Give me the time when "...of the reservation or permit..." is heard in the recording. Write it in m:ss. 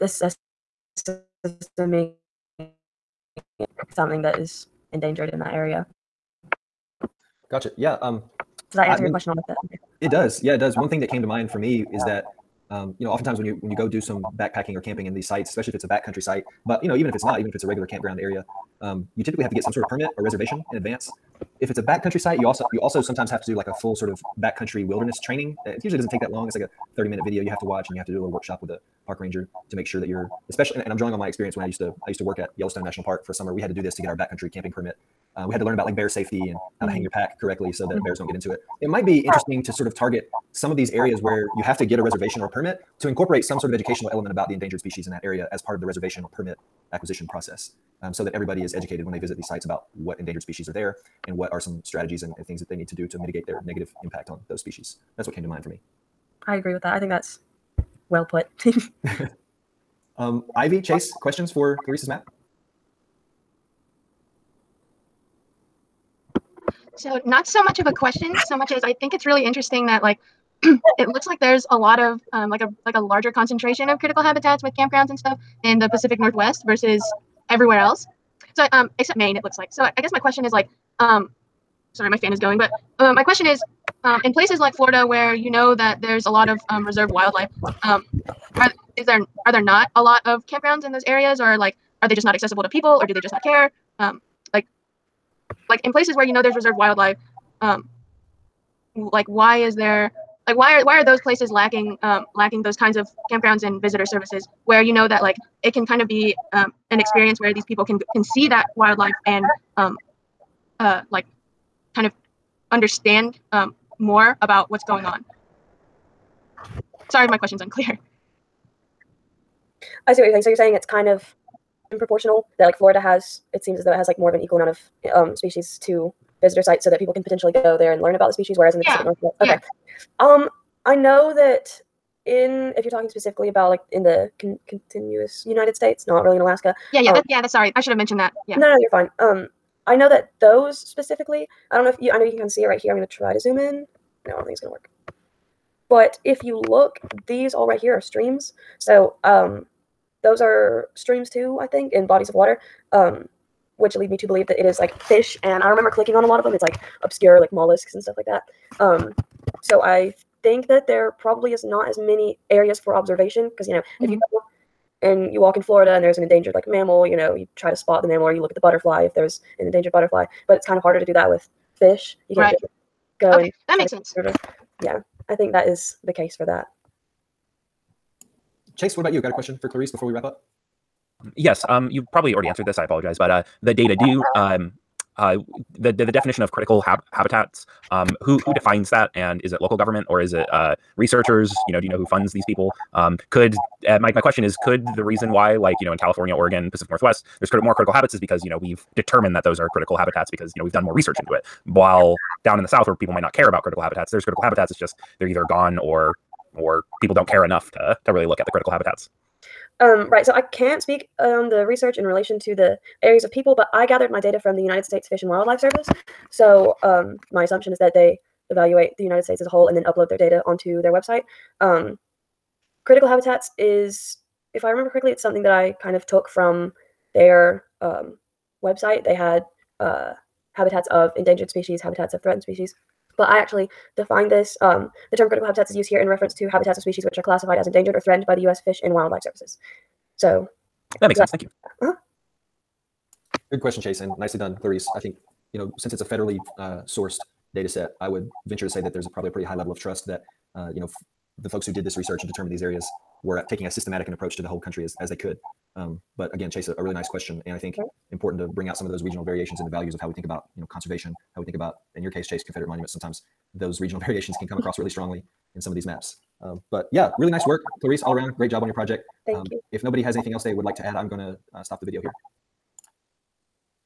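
0:45.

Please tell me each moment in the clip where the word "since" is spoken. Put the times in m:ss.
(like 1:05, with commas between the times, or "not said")
4:05.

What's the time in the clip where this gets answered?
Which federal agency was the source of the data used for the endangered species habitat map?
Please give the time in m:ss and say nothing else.
3:34.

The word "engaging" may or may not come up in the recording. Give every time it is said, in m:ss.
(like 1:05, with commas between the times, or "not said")
not said.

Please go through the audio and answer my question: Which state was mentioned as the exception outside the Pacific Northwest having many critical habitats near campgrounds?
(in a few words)
Maine.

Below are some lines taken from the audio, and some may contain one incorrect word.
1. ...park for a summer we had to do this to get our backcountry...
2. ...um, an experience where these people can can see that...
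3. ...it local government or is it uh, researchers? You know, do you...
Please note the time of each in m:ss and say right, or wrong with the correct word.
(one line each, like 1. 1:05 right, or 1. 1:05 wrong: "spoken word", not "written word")
1. 0:33 right
2. 1:46 right
3. 3:09 right.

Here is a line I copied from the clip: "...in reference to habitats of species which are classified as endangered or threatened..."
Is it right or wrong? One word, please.
right.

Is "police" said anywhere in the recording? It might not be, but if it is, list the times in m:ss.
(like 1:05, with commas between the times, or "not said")
not said.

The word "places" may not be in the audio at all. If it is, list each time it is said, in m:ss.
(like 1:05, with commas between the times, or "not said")
1:24, 1:35, 1:41.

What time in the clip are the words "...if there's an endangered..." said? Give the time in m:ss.
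2:49.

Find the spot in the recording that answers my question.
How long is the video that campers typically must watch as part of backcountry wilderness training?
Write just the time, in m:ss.
0:26.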